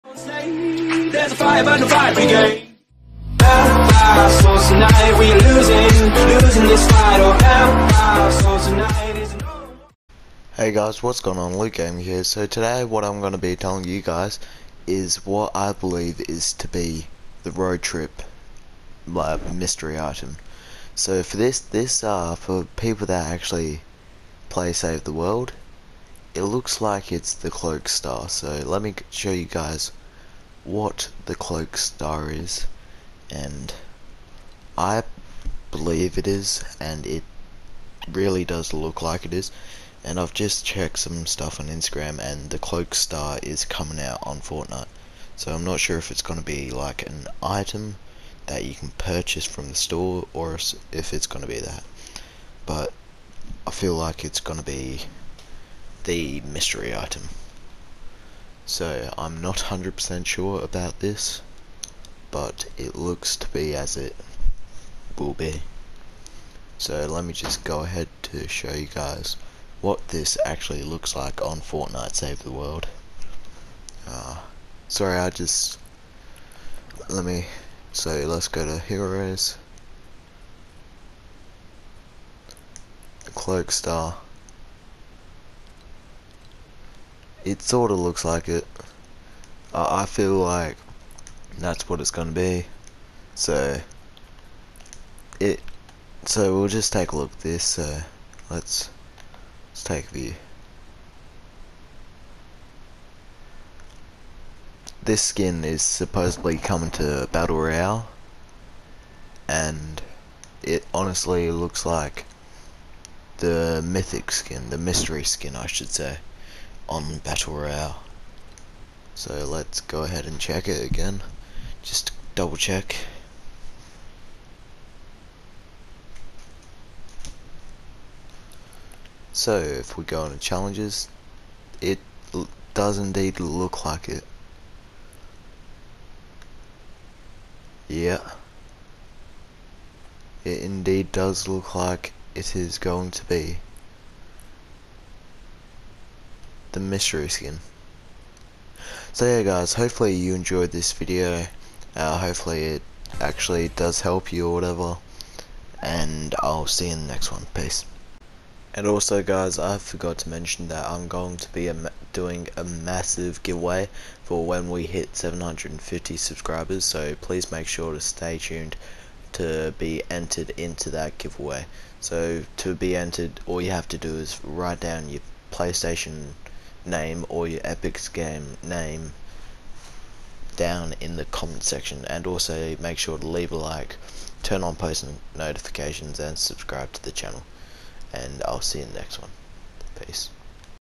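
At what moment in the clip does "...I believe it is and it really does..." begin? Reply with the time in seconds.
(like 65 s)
34 s.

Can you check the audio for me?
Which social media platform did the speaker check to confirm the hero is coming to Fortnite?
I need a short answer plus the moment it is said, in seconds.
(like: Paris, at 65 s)
Instagram, at 41 s.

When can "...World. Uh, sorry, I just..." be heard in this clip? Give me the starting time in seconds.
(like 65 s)
72 s.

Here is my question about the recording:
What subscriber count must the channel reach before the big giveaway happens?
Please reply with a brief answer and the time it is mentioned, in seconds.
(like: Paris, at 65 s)
750, at 165 s.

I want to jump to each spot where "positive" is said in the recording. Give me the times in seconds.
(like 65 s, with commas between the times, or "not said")
not said.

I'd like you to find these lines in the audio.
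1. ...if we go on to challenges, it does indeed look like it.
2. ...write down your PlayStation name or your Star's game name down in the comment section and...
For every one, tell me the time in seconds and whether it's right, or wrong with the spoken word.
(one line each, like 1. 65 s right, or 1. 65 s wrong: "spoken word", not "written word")
1. 129 s right
2. 174 s wrong: "Epic", not "Star".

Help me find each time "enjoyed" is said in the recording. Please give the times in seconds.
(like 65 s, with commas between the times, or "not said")
150 s.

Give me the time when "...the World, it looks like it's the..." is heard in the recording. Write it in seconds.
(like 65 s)
25 s.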